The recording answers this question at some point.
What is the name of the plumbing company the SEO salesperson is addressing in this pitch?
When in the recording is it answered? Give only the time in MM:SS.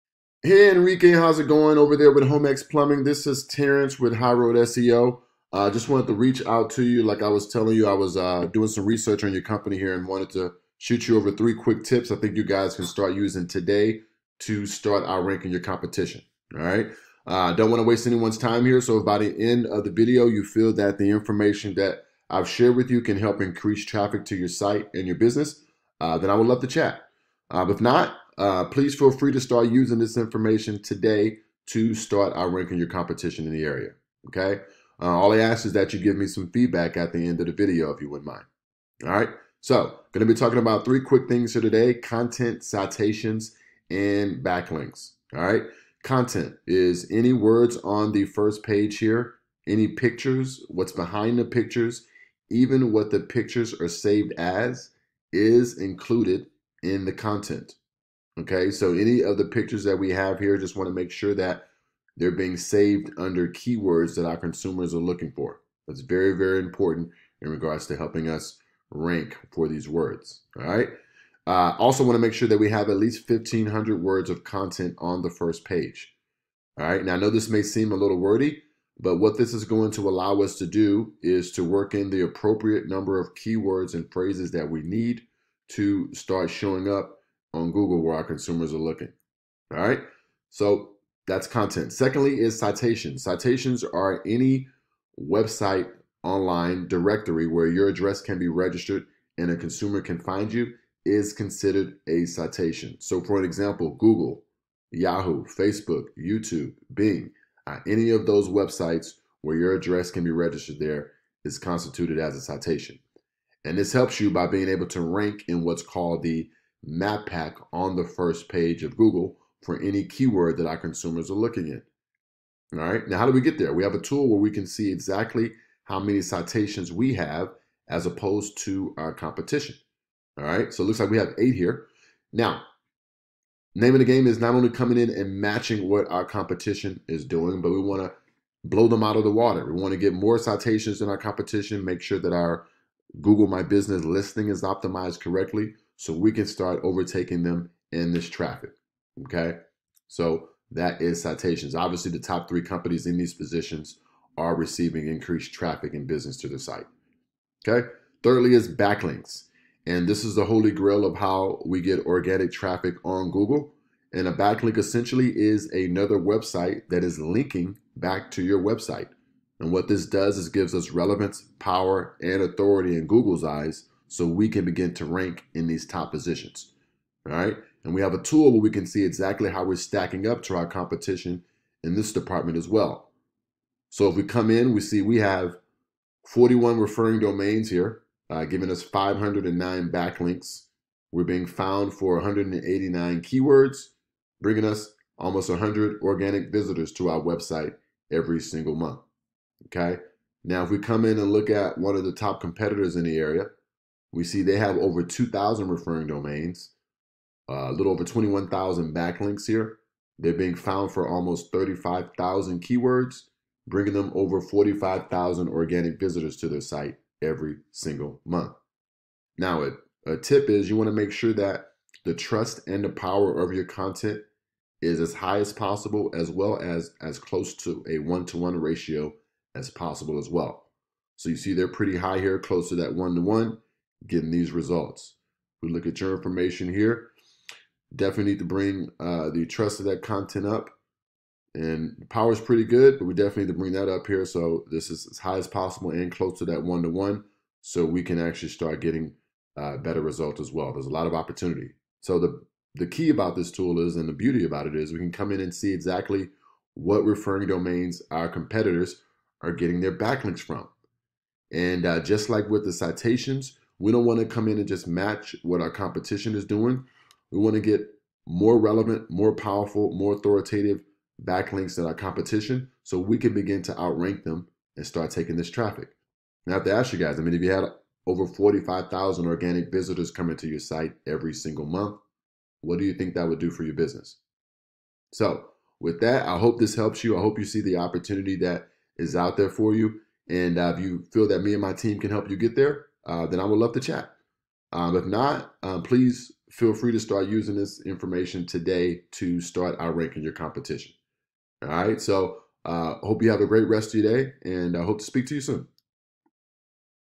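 00:02.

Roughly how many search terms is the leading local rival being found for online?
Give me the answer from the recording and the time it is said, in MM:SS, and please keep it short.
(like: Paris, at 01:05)
35,000, at 03:31.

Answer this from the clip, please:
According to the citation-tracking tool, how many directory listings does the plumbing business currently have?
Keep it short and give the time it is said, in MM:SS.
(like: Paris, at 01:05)
8, at 02:11.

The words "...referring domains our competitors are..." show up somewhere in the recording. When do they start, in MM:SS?
04:17.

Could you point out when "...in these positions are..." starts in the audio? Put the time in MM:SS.
02:33.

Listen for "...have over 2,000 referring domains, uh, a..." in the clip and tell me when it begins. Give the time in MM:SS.
03:24.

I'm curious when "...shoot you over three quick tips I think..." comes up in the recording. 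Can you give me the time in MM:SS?
00:10.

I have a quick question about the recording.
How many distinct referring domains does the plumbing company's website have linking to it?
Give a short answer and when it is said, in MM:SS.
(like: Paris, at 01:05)
41, at 03:06.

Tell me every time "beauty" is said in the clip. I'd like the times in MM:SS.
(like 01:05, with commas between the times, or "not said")
04:14.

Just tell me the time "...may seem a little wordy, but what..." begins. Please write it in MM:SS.
01:17.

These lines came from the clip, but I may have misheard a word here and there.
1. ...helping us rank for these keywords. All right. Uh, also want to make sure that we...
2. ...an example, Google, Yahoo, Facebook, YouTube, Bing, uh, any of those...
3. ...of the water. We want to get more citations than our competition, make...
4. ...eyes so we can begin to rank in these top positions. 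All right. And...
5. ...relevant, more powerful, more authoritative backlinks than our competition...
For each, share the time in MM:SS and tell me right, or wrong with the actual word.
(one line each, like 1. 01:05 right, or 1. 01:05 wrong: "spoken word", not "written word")
1. 01:07 wrong: "words", not "keywords"
2. 01:43 right
3. 02:19 right
4. 02:53 right
5. 04:28 right.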